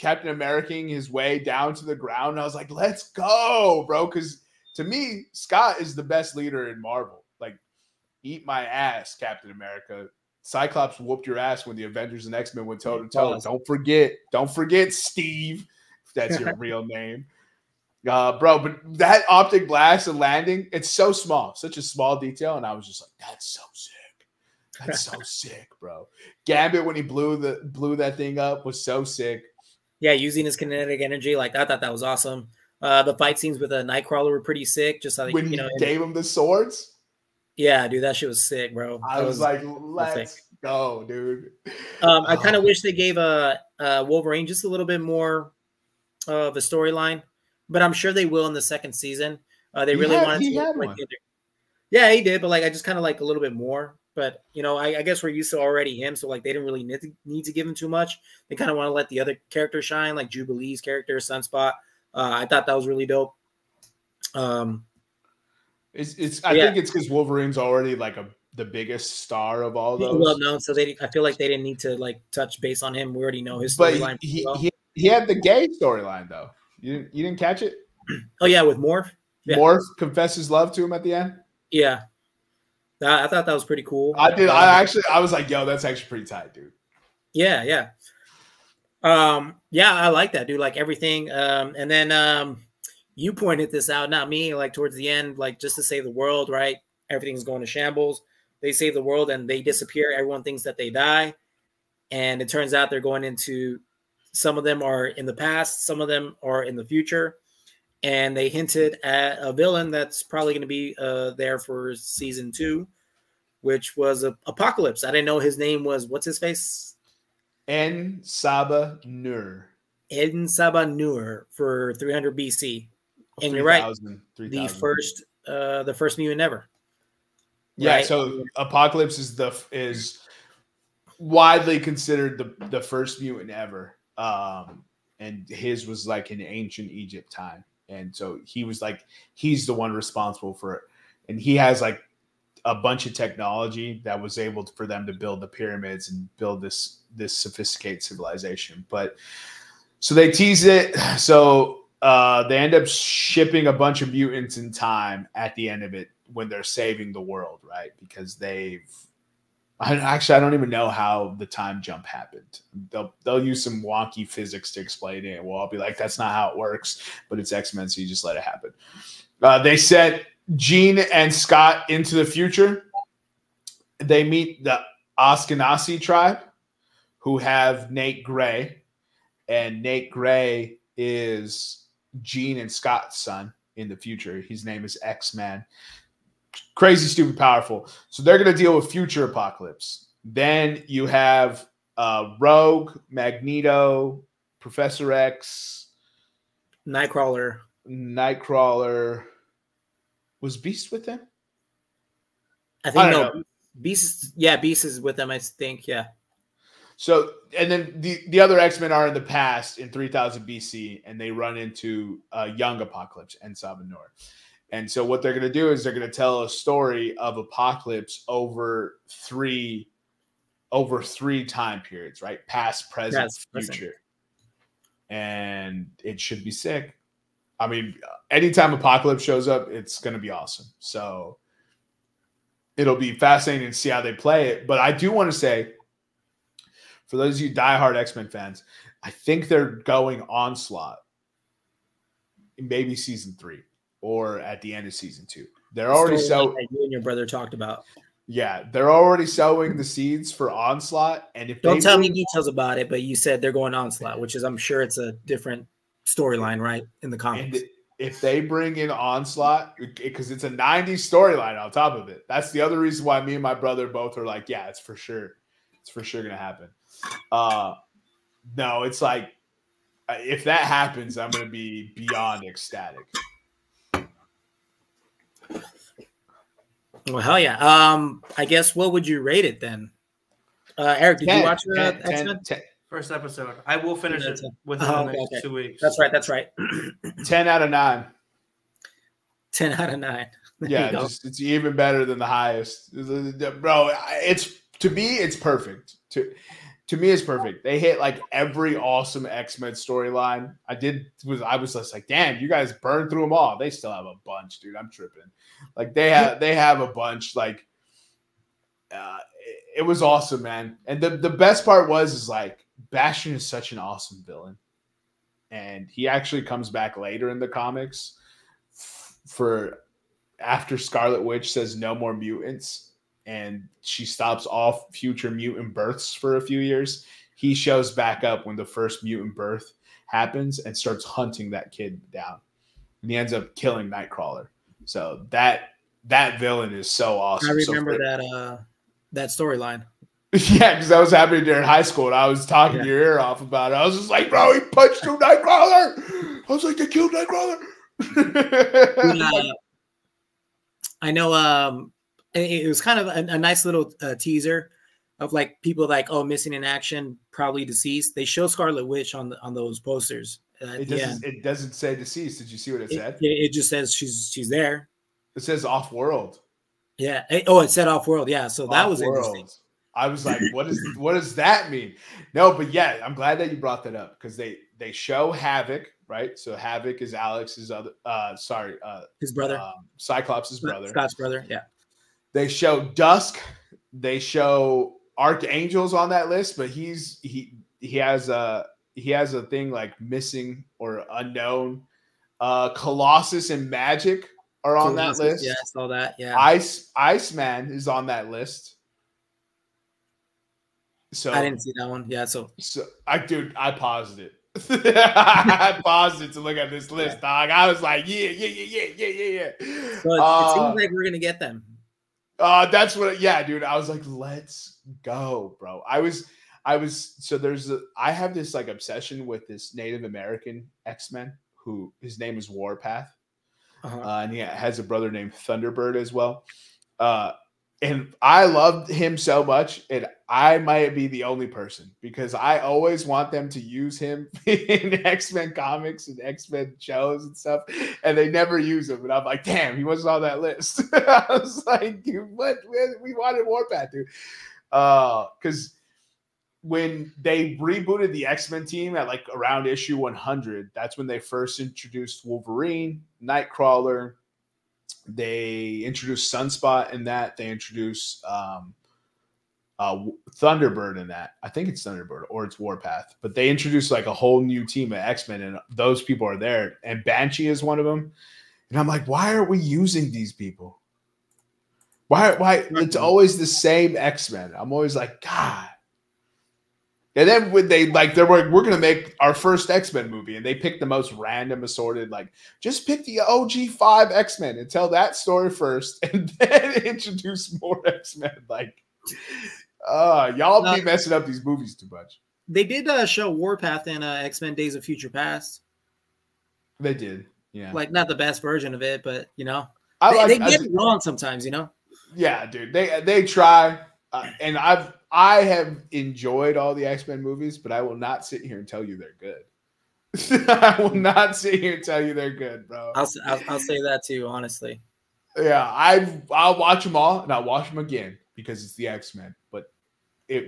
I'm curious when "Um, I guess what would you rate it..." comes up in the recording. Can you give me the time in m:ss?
4:37.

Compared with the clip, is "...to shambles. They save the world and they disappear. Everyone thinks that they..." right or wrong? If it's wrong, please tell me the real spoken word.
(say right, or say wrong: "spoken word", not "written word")
right.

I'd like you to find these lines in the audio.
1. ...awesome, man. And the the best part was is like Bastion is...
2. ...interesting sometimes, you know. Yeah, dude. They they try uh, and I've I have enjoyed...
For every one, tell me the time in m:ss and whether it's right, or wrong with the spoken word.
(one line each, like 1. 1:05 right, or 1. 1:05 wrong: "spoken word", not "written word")
1. 5:10 right
2. 8:20 wrong: "wrong", not "interesting".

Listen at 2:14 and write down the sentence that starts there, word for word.
Um and his was like in ancient Egypt time.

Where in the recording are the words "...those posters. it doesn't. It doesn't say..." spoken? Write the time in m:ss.
5:59.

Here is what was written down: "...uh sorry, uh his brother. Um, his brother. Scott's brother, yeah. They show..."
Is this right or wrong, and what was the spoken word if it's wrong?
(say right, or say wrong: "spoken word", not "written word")
right.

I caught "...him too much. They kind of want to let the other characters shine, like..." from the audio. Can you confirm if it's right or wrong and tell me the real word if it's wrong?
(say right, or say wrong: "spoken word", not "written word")
right.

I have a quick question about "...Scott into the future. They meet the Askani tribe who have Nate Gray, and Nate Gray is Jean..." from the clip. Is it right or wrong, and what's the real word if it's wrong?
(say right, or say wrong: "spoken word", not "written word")
right.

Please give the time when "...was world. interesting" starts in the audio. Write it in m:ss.
6:08.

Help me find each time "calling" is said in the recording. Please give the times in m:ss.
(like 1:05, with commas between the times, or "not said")
not said.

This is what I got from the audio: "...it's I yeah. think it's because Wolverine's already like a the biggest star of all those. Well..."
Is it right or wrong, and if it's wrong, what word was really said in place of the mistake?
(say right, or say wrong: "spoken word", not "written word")
right.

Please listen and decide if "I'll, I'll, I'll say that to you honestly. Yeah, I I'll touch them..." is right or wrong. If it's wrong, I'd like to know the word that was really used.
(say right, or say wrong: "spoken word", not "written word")
wrong: "watch", not "touch".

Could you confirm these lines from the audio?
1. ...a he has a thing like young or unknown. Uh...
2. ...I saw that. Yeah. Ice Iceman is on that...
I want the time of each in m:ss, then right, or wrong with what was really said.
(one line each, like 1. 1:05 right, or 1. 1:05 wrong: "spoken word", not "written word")
1. 6:28 wrong: "missing", not "young"
2. 6:35 right.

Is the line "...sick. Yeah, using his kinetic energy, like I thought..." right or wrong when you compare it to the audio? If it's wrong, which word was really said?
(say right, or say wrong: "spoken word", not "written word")
right.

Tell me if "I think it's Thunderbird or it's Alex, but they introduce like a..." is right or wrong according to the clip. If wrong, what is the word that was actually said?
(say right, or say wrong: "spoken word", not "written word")
wrong: "Warpath", not "Alex".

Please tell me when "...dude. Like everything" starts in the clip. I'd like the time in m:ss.
1:30.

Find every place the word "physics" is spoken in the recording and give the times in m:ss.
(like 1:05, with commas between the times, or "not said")
2:44.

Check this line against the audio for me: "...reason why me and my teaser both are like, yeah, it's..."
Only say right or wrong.
wrong.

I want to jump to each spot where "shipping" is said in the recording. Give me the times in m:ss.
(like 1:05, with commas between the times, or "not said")
2:32.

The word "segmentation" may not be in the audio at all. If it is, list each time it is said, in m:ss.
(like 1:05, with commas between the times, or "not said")
not said.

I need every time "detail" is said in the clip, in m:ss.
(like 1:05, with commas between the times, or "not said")
0:22, 4:12.